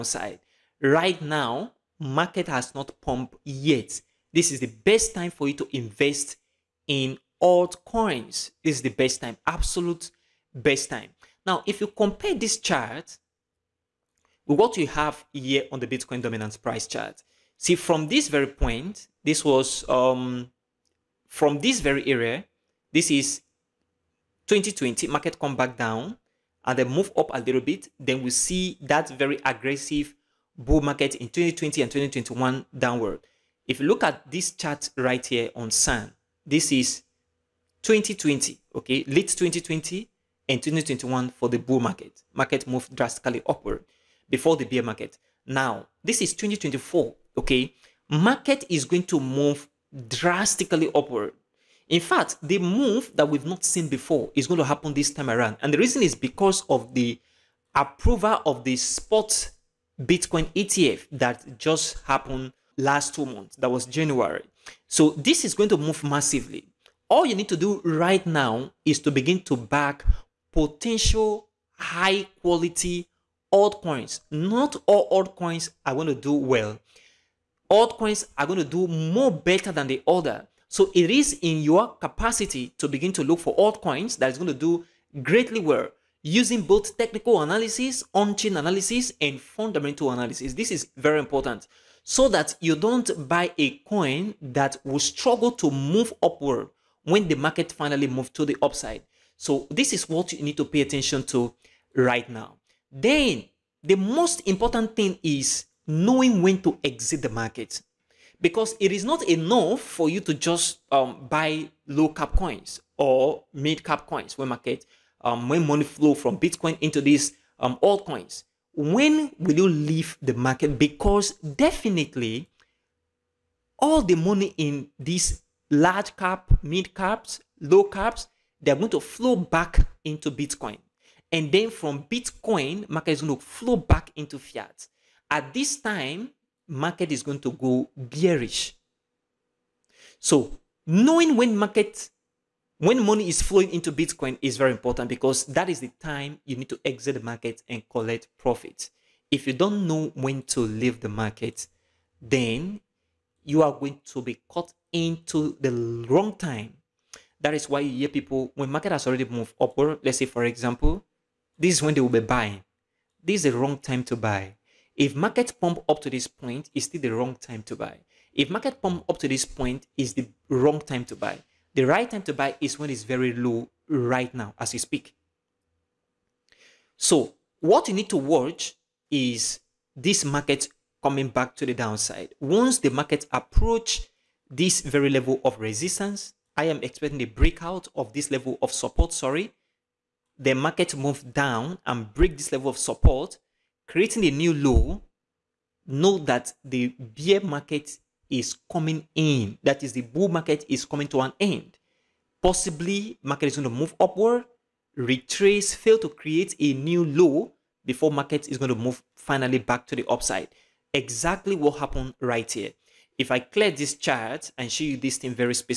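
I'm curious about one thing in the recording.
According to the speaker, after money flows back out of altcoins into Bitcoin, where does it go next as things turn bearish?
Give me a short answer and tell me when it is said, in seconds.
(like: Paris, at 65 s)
Fiat, at 134 s.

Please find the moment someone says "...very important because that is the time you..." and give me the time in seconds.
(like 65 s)
144 s.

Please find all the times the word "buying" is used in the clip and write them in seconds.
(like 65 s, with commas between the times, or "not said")
162 s.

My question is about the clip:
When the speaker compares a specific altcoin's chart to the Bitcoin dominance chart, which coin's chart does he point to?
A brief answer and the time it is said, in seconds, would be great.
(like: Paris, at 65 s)
SAND, at 35 s.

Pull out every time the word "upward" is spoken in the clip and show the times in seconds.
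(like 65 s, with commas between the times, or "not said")
43 s, 50 s, 96 s, 159 s, 203 s.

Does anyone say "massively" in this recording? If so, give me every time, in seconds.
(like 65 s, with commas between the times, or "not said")
66 s.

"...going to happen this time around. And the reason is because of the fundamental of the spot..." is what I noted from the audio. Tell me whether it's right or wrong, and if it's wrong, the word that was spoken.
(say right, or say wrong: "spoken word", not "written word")
wrong: "approval", not "fundamental".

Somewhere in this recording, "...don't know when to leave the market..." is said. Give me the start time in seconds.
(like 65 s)
149 s.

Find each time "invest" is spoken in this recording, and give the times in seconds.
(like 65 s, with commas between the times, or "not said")
5 s.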